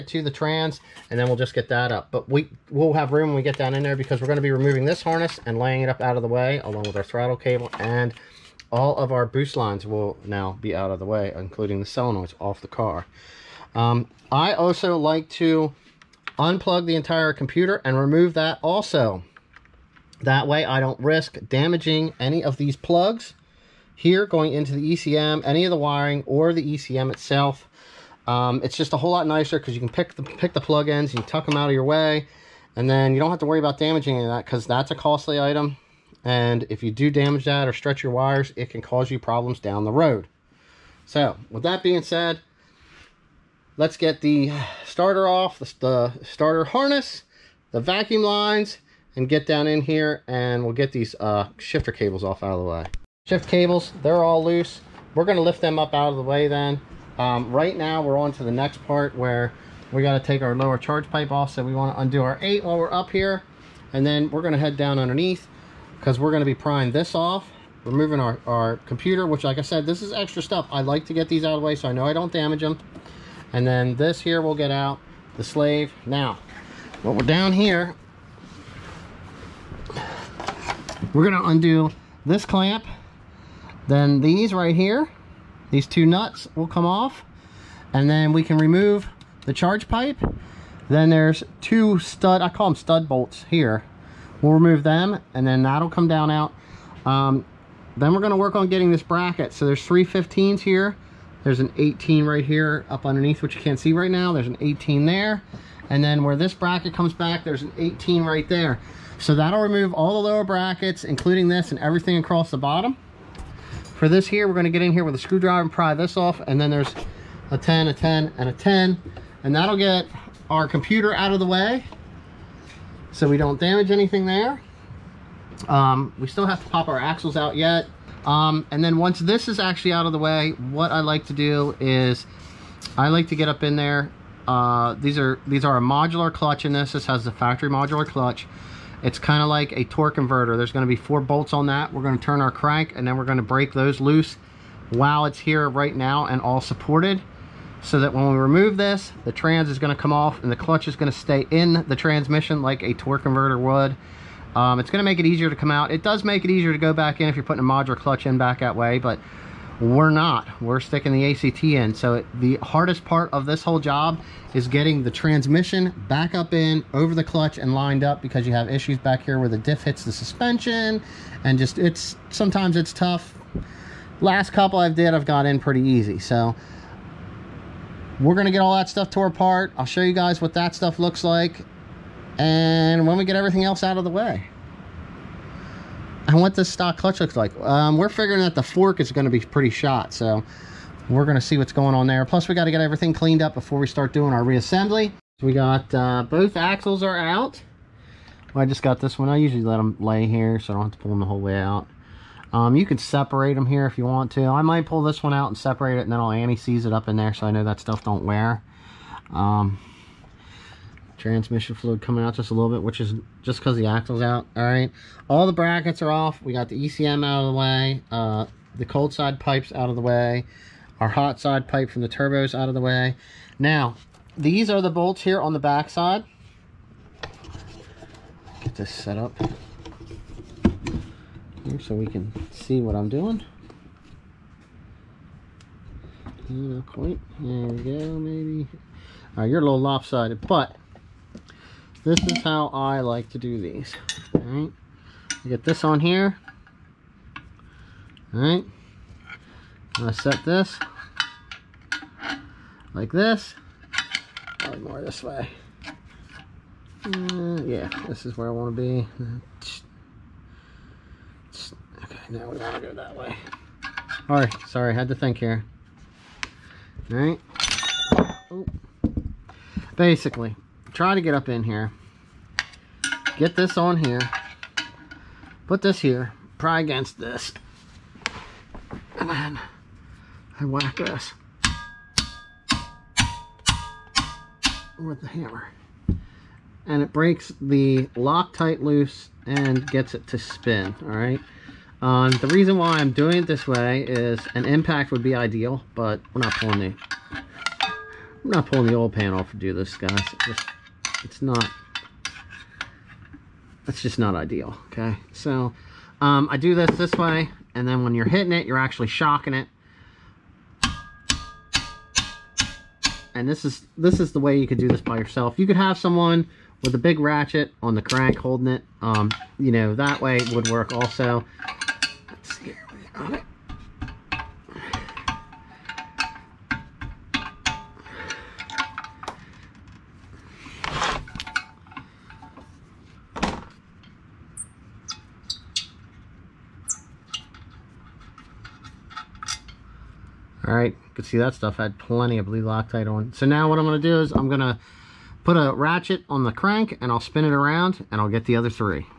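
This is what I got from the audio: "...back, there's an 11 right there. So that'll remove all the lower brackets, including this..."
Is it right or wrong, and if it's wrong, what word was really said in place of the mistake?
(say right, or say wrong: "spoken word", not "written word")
wrong: "18", not "11".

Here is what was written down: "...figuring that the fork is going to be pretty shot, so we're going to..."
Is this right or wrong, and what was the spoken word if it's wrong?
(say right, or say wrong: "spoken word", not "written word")
right.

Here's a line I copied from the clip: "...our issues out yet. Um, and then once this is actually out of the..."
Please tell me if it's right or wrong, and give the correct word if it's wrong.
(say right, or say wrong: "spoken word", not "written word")
wrong: "axles", not "issues".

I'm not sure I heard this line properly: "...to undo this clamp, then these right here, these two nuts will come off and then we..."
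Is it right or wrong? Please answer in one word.
right.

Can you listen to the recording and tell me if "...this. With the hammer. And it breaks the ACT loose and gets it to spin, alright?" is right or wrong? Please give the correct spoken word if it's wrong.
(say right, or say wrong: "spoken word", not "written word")
wrong: "Loctite", not "ACT".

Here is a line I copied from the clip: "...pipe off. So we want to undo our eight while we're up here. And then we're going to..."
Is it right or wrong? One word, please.
right.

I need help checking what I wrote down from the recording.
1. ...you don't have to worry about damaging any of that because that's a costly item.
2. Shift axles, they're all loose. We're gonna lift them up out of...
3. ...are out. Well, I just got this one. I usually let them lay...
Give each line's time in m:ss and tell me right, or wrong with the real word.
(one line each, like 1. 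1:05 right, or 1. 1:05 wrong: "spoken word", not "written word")
1. 0:33 right
2. 0:53 wrong: "cables", not "axles"
3. 3:17 right.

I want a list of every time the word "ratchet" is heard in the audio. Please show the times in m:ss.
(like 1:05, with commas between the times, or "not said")
5:17, 5:45.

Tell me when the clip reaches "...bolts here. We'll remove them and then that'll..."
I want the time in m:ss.
1:33.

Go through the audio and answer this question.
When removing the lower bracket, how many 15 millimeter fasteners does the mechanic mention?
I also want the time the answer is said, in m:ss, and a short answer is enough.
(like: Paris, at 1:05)
3, at 1:39.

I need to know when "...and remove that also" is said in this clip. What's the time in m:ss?
0:17.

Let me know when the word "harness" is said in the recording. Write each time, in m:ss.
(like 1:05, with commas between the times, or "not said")
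0:05, 0:46.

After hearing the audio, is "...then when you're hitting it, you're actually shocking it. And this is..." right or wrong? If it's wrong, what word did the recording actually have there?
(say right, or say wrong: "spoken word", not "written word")
right.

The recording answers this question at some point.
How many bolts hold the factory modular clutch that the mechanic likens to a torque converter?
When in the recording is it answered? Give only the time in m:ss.
2:20.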